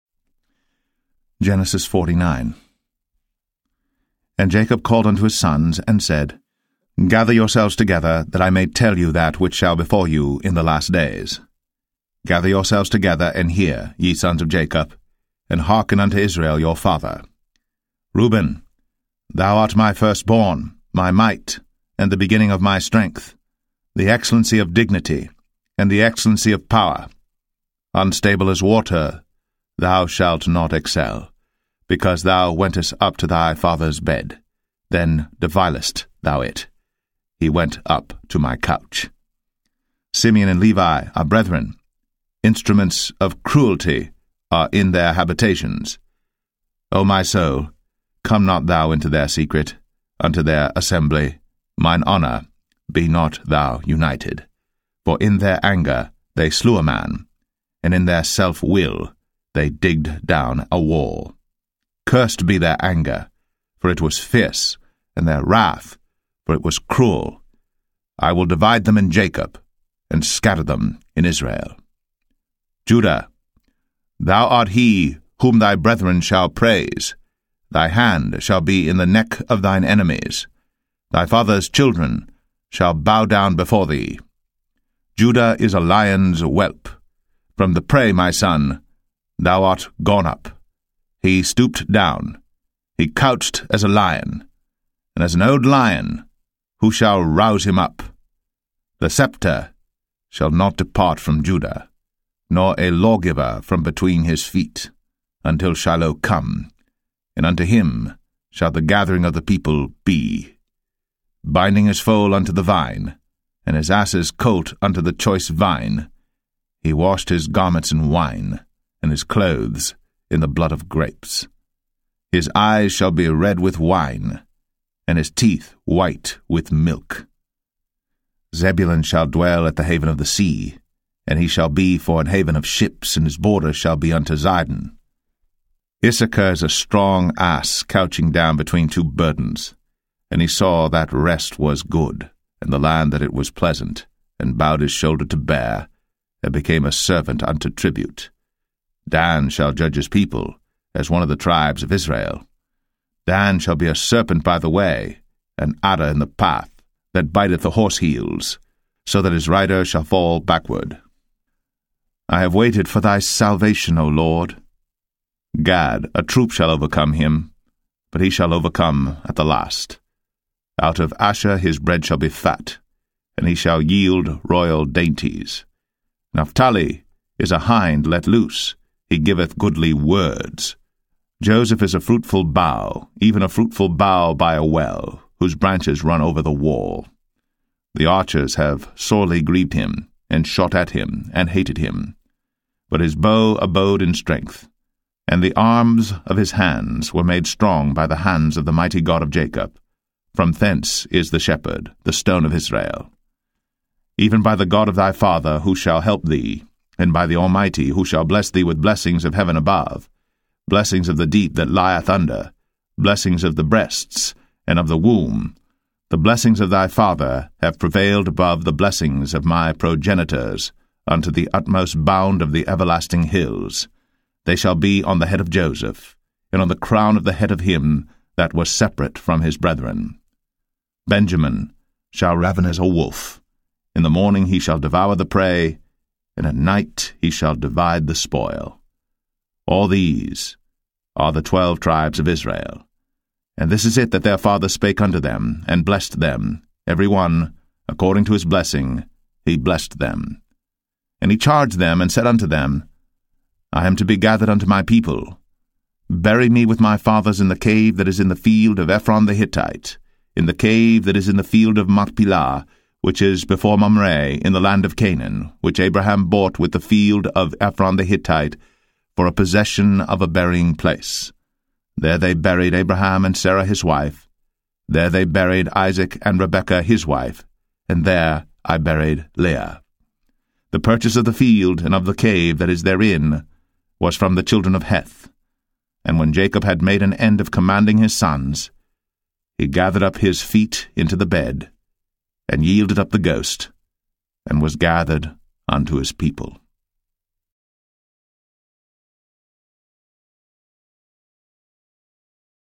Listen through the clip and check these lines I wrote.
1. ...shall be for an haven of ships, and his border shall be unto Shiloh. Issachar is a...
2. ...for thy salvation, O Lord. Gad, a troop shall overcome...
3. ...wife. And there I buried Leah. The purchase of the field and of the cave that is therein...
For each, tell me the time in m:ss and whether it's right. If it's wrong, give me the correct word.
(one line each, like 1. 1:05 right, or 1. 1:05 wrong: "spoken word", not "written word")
1. 2:11 wrong: "Zidon", not "Shiloh"
2. 2:42 right
3. 4:37 right.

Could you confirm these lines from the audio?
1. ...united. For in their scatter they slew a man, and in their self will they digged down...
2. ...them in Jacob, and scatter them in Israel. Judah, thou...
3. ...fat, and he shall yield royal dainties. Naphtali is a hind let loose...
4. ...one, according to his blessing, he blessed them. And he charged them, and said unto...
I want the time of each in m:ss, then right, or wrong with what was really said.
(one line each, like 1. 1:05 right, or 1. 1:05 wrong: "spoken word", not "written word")
1. 0:53 wrong: "anger", not "scatter"
2. 1:08 right
3. 2:52 right
4. 4:07 right.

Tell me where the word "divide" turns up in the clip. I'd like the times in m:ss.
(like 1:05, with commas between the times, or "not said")
1:08, 3:57.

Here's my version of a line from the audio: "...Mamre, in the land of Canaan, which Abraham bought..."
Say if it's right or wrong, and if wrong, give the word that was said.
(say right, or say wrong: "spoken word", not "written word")
right.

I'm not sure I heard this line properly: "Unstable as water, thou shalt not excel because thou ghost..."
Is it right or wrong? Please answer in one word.
wrong.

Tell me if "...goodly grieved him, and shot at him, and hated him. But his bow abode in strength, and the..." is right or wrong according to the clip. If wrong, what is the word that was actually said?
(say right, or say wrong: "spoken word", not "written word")
wrong: "sorely", not "goodly".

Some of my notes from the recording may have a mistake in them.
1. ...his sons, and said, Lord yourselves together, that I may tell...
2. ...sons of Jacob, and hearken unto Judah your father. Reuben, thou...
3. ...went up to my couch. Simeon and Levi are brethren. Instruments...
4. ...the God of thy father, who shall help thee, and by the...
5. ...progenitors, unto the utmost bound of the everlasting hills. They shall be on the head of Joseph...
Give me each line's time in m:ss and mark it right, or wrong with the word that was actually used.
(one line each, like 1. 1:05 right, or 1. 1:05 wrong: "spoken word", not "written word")
1. 0:05 wrong: "Gather", not "Lord"
2. 0:14 wrong: "Israel", not "Judah"
3. 0:37 right
4. 3:24 right
5. 3:39 right.